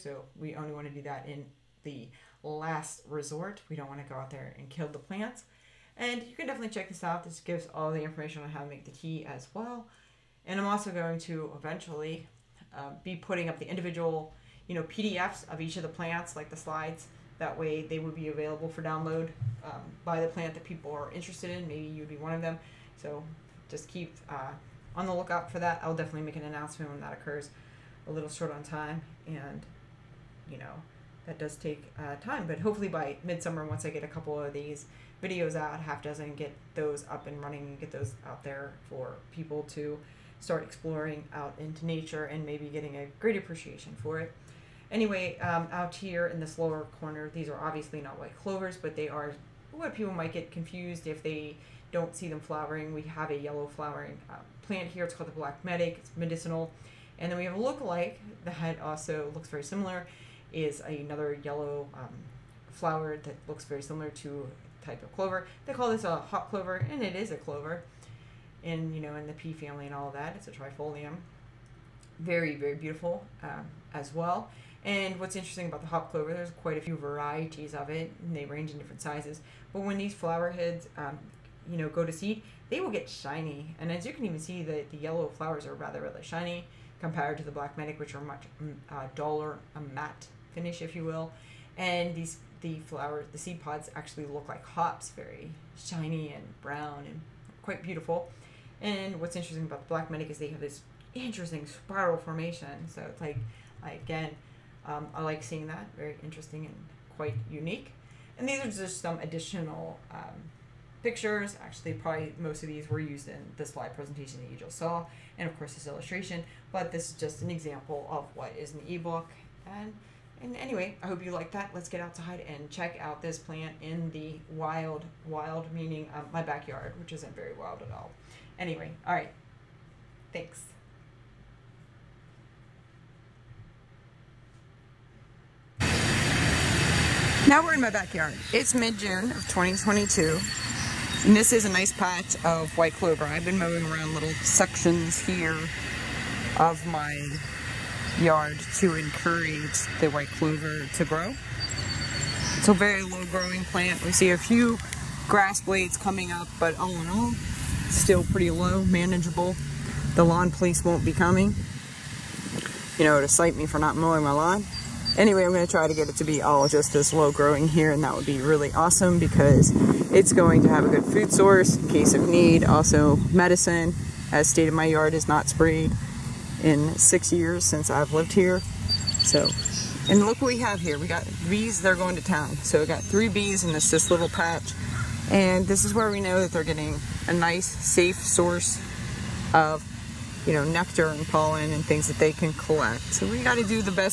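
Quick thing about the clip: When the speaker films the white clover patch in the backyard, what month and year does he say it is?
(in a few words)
June 2022.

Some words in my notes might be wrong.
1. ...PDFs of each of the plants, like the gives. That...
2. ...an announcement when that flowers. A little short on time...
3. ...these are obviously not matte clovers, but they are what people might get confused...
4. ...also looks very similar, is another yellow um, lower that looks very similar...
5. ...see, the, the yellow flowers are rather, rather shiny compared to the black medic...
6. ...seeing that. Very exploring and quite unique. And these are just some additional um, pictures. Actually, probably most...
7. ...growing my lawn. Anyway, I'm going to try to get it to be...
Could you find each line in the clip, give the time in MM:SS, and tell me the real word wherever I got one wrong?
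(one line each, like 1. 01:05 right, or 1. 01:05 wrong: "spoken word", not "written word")
1. 00:14 wrong: "slides", not "gives"
2. 00:26 wrong: "occurs", not "flowers"
3. 00:47 wrong: "white", not "matte"
4. 00:58 wrong: "flower", not "lower"
5. 01:24 right
6. 01:45 wrong: "interesting", not "exploring"
7. 02:43 wrong: "mowing", not "growing".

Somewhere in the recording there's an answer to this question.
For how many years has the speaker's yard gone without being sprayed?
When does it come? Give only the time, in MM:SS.
02:56.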